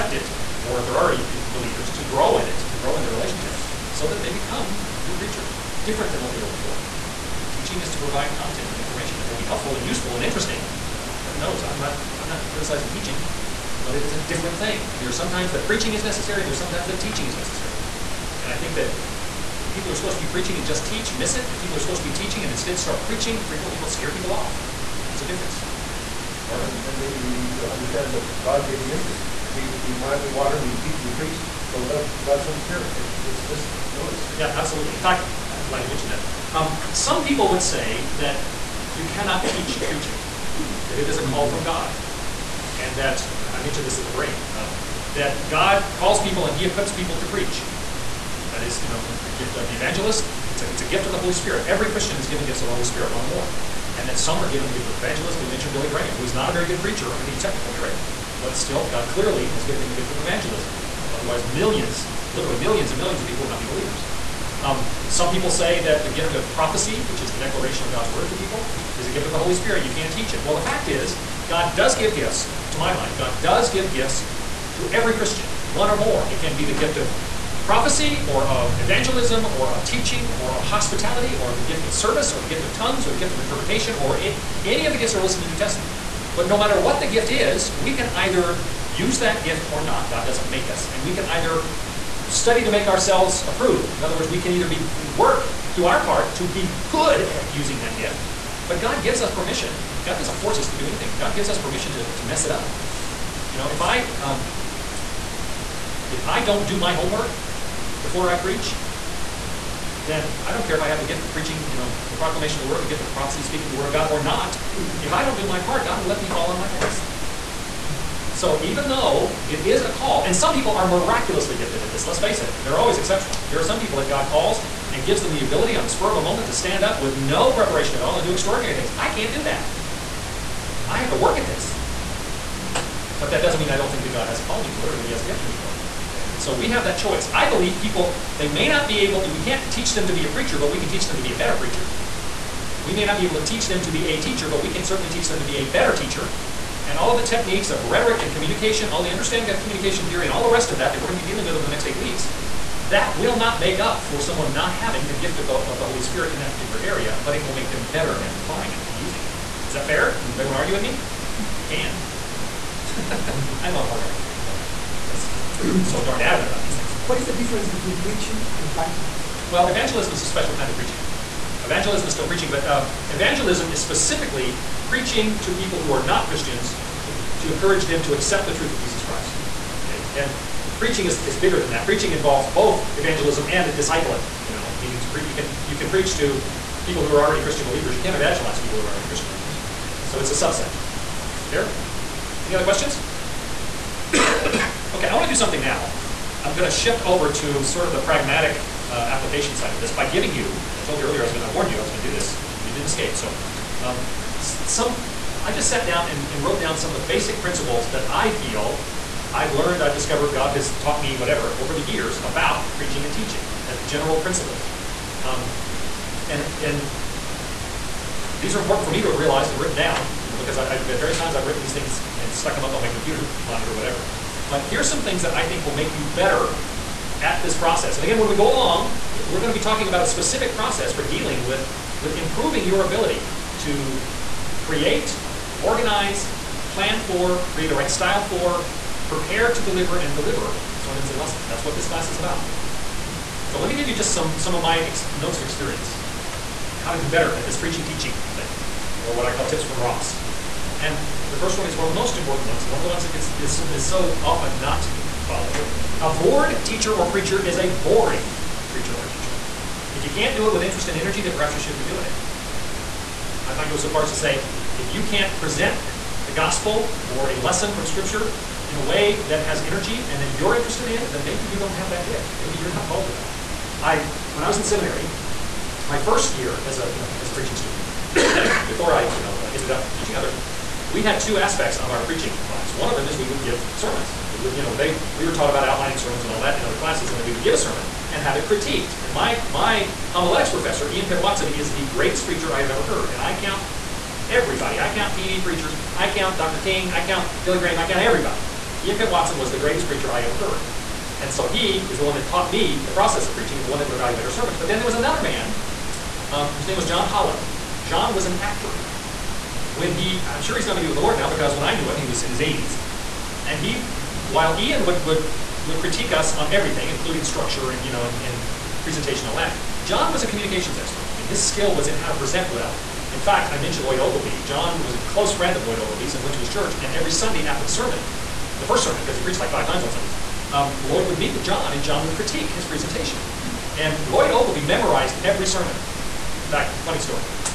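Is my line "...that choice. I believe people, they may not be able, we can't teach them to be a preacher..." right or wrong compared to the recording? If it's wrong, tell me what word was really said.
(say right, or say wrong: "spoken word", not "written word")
right.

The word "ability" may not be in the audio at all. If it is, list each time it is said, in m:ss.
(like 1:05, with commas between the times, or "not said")
2:05, 3:52.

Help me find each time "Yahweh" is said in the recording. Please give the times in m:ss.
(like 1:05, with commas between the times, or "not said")
not said.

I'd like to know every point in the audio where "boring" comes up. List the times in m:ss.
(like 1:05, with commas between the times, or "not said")
4:17.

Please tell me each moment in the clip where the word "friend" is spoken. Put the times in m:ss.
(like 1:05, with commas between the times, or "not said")
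5:25.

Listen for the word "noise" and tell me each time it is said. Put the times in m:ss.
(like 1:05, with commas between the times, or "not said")
0:33.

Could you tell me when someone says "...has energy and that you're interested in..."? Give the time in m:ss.
4:29.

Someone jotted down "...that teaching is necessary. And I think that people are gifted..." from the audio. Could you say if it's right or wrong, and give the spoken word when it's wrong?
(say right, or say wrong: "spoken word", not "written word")
wrong: "supposed", not "gifted".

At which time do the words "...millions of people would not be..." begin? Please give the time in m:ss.
1:02.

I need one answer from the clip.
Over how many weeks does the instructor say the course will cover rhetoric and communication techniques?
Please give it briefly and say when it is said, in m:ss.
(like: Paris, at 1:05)
8, at 2:31.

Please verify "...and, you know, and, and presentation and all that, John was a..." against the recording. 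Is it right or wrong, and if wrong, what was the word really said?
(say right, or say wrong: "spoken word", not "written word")
right.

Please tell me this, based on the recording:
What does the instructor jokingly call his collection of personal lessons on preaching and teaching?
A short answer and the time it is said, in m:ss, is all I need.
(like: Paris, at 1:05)
Tips from Ross, at 4:09.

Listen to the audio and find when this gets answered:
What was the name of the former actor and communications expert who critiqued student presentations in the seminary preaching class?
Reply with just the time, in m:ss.
5:06.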